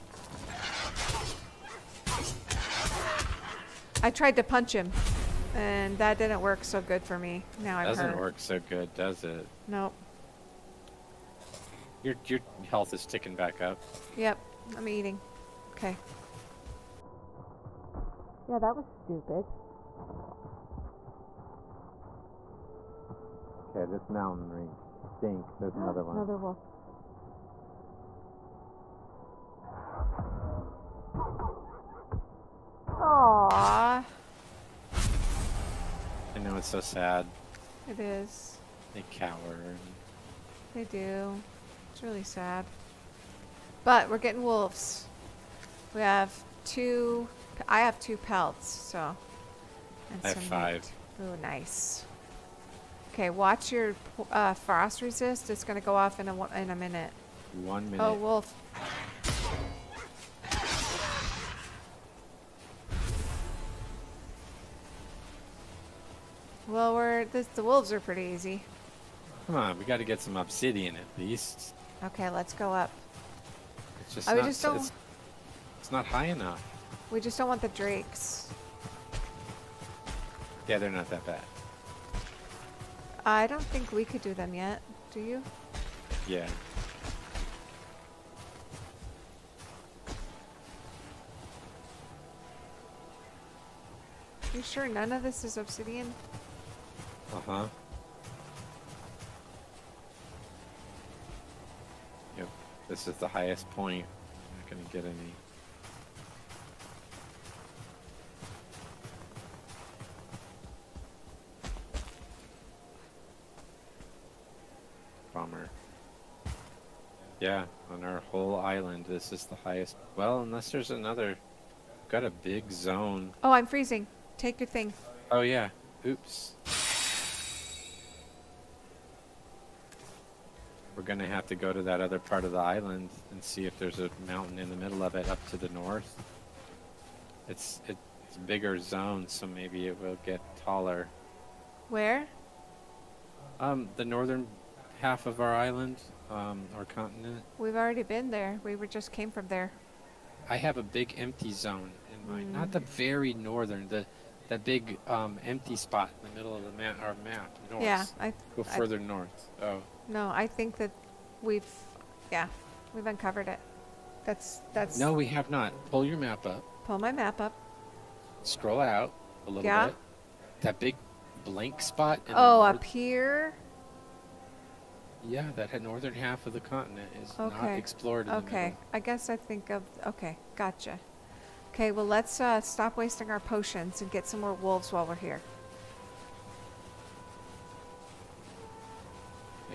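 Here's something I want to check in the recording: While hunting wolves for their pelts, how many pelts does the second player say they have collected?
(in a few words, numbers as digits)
5.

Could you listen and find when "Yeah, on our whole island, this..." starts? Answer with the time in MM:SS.
01:57.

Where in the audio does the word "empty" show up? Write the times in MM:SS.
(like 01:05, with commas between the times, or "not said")
02:31, 02:35.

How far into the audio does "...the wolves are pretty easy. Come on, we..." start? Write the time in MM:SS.
01:07.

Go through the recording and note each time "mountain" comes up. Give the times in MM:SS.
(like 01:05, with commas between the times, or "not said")
00:24, 02:14.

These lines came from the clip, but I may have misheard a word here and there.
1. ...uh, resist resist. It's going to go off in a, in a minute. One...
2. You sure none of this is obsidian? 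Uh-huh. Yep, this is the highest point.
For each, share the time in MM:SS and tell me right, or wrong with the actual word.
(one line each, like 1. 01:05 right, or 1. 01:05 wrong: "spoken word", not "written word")
1. 00:54 wrong: "frost", not "resist"
2. 01:34 right.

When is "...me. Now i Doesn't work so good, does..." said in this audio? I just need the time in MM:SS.
00:07.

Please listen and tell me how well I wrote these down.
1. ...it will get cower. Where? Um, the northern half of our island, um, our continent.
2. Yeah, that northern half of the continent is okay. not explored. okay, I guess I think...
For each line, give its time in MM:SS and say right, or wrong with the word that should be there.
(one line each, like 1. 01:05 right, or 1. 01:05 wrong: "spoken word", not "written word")
1. 02:19 wrong: "taller", not "cower"
2. 02:55 right.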